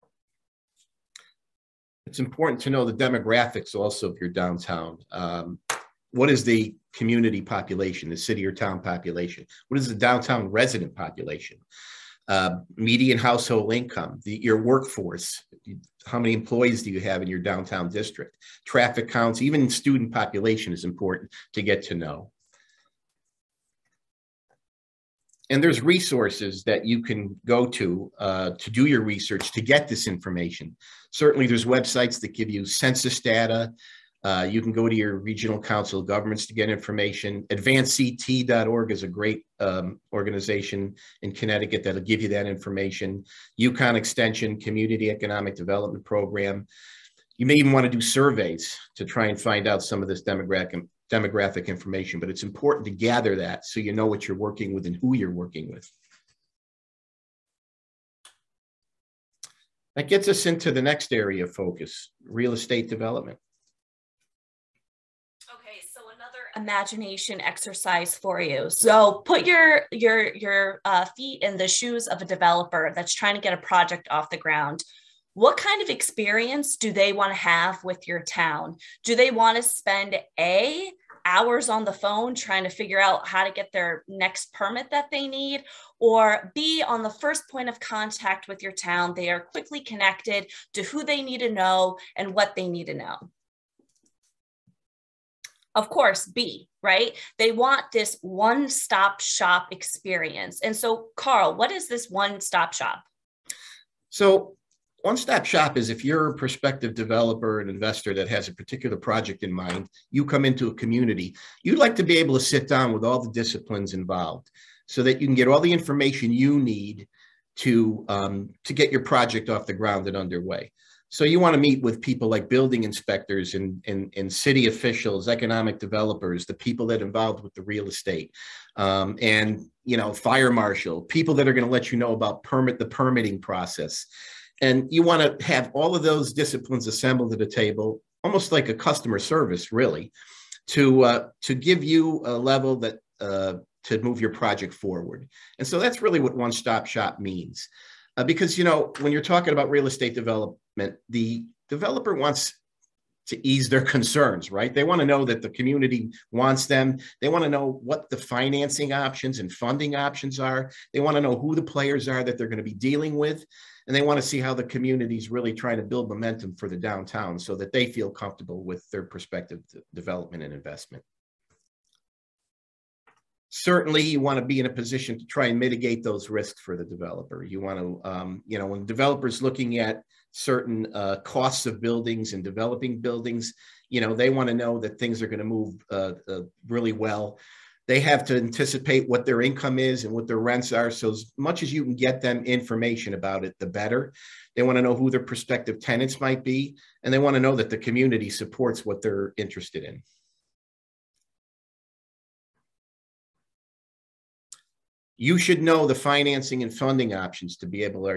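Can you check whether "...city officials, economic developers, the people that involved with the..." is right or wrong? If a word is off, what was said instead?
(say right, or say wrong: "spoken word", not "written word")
right.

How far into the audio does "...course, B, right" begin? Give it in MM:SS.
01:35.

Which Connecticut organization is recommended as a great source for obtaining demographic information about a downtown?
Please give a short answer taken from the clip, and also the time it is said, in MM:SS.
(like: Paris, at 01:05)
AdvanceCT.org, at 00:37.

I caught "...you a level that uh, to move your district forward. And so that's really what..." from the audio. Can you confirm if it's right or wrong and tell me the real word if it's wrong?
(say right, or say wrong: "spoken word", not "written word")
wrong: "project", not "district".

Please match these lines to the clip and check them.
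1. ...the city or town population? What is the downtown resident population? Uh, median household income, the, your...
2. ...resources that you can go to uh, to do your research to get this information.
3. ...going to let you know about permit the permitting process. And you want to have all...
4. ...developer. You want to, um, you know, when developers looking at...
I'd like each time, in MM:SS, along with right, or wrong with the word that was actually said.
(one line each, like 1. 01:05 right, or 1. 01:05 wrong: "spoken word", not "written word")
1. 00:08 right
2. 00:25 right
3. 02:11 right
4. 02:56 right.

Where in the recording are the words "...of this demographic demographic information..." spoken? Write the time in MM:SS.
00:50.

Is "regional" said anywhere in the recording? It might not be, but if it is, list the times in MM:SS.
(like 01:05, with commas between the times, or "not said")
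00:35.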